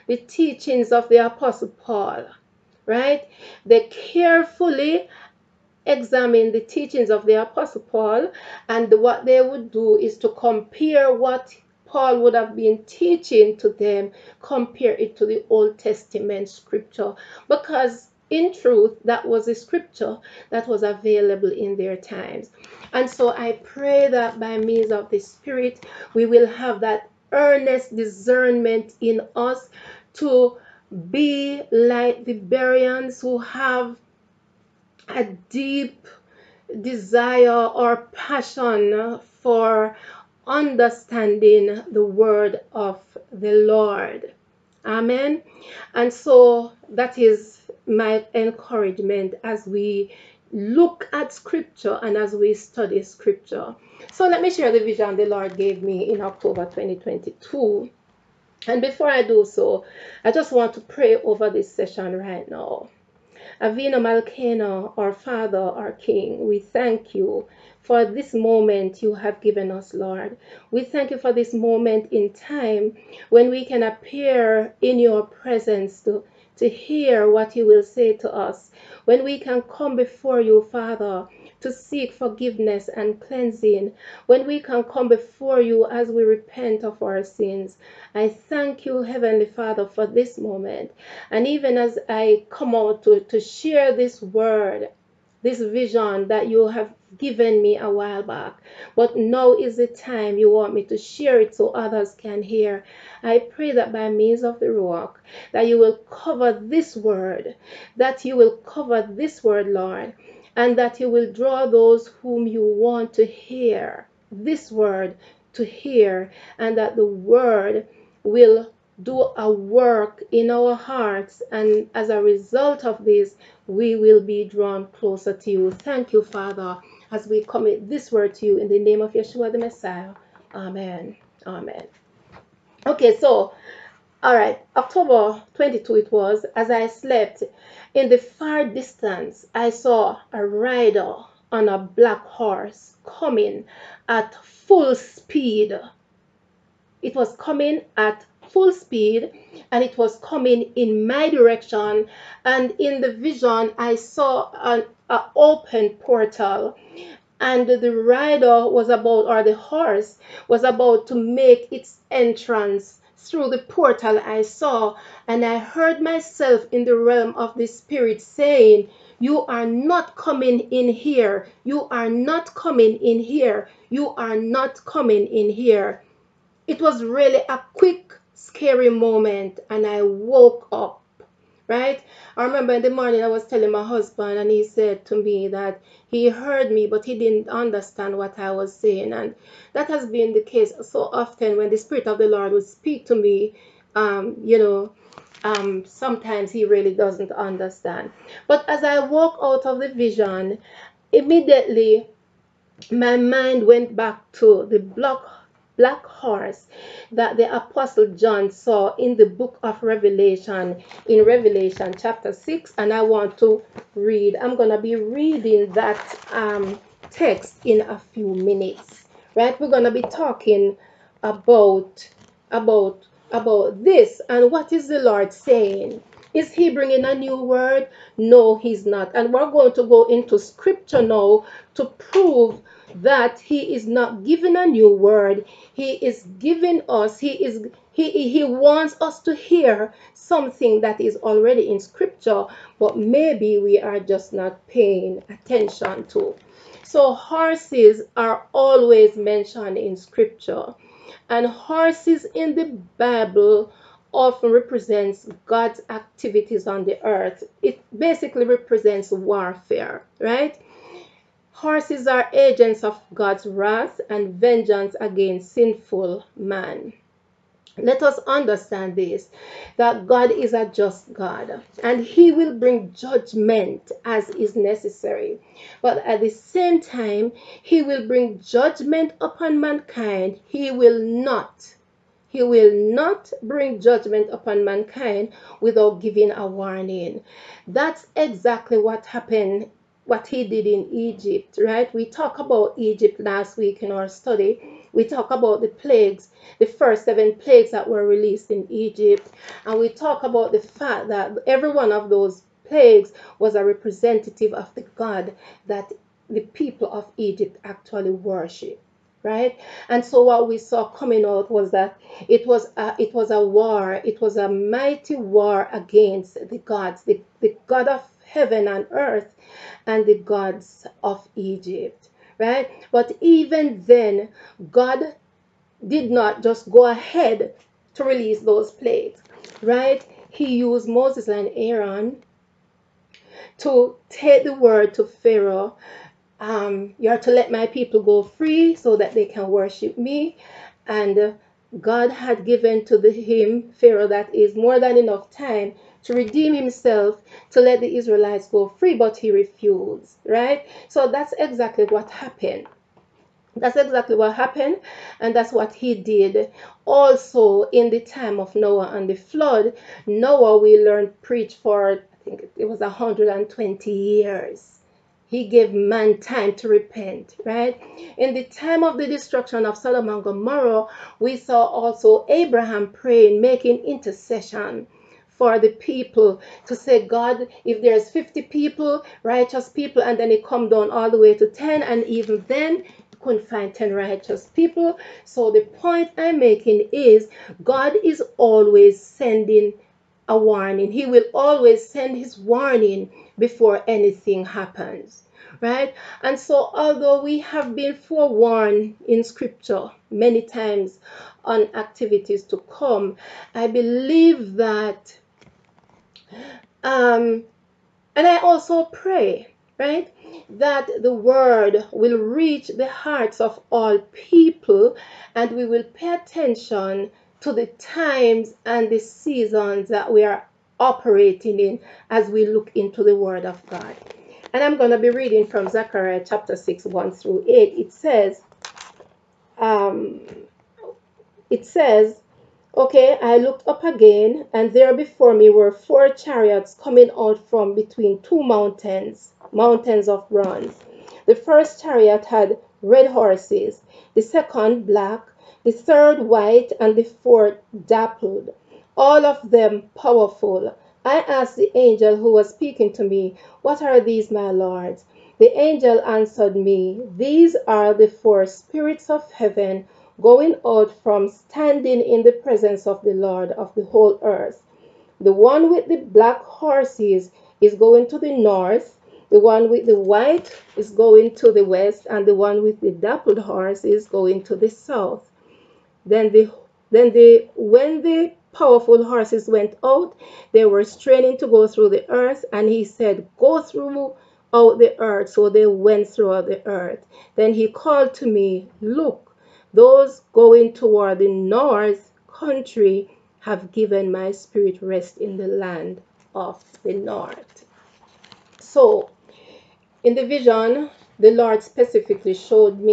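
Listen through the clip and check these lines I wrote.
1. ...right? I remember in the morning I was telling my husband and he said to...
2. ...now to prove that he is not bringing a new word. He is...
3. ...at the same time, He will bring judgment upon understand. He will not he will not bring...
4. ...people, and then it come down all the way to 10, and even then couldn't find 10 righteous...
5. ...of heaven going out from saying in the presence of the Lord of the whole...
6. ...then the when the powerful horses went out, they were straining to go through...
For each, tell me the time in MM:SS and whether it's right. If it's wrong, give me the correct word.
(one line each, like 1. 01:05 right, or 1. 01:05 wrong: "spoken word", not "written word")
1. 03:01 right
2. 03:51 wrong: "giving", not "bringing"
3. 04:36 wrong: "mankind", not "understand"
4. 06:19 right
5. 07:39 wrong: "standing", not "saying"
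6. 07:56 right.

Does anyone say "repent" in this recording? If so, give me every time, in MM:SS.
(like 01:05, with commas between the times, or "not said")
01:26, 06:06.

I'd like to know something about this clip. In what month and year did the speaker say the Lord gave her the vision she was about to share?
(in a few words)
October 2022.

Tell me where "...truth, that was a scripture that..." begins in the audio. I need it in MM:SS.
00:18.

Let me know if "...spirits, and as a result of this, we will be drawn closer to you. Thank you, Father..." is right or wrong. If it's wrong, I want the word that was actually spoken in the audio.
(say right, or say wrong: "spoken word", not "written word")
wrong: "hearts", not "spirits".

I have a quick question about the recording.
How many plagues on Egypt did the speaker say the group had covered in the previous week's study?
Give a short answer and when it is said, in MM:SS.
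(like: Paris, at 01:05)
7, at 04:57.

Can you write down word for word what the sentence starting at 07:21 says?
The first chariot had red horses, the second black, the third white, and the fourth dappled, all of them powerful.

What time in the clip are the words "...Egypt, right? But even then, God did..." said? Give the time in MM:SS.
05:21.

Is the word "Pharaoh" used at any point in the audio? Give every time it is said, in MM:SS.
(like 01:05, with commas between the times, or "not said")
05:35, 05:43.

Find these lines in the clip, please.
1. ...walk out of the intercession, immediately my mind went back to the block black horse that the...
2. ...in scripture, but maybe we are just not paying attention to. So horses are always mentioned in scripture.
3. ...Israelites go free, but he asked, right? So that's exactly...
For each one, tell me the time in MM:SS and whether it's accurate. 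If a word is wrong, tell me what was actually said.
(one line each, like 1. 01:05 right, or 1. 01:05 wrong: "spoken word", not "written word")
1. 03:18 wrong: "vision", not "intercession"
2. 04:01 right
3. 05:47 wrong: "refused", not "asked".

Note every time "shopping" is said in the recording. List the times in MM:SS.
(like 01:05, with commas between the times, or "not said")
not said.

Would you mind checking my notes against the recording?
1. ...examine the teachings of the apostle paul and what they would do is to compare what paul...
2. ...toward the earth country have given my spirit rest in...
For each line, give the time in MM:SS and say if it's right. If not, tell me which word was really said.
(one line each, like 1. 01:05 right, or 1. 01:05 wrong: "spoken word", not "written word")
1. 00:05 right
2. 08:10 wrong: "north", not "earth".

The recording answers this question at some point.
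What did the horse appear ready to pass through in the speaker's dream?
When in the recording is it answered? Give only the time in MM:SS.
02:35.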